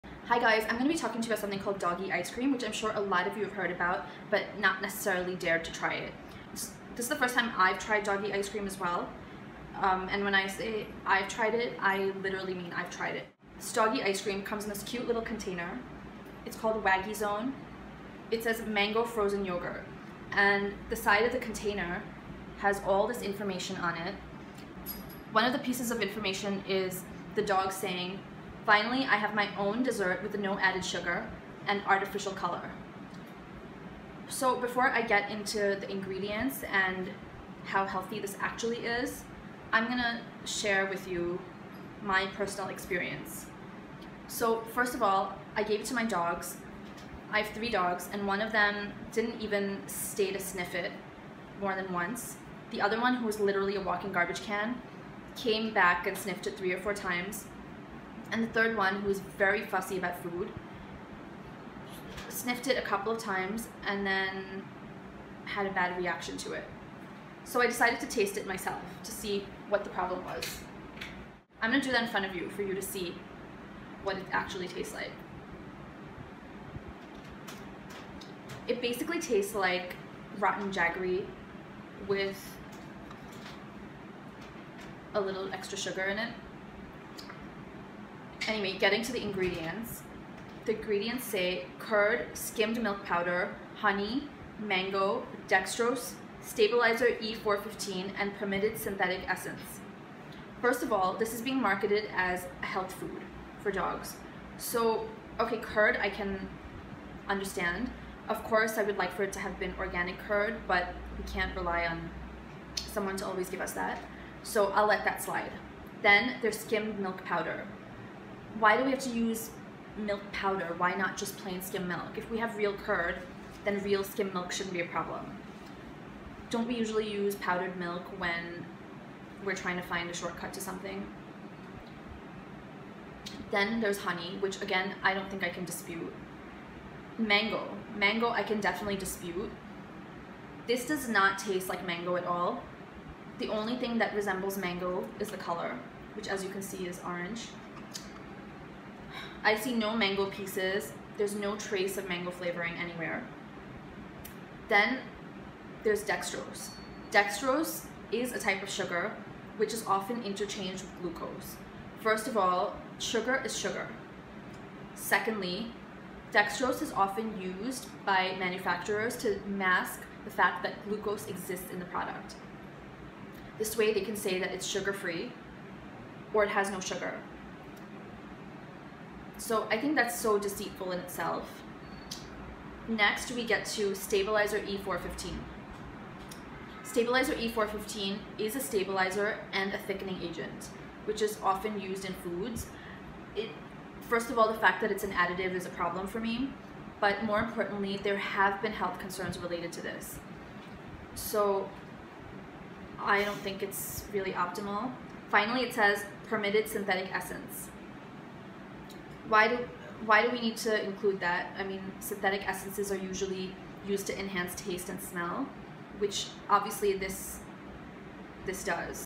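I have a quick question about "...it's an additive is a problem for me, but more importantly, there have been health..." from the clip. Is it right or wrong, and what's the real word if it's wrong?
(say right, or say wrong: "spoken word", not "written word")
right.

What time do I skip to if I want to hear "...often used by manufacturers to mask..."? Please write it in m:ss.
2:46.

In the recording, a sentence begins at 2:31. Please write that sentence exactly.
There's no trace of mango flavoring anywhere.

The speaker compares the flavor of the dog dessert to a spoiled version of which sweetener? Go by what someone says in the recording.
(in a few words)
jaggery.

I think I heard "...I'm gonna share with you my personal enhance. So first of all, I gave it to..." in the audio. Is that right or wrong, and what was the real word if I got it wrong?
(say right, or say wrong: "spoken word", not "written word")
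wrong: "experience", not "enhance".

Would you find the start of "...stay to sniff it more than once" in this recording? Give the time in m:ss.
0:49.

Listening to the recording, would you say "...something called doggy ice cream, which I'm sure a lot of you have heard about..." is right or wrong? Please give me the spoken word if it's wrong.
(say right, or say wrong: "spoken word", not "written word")
right.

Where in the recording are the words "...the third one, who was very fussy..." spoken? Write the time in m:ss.
0:58.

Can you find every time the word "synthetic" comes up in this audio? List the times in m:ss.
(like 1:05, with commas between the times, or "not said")
1:38, 3:26, 3:31.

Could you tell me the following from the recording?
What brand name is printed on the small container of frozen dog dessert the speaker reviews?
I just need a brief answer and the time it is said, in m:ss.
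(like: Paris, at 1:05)
Waggy Zone, at 0:16.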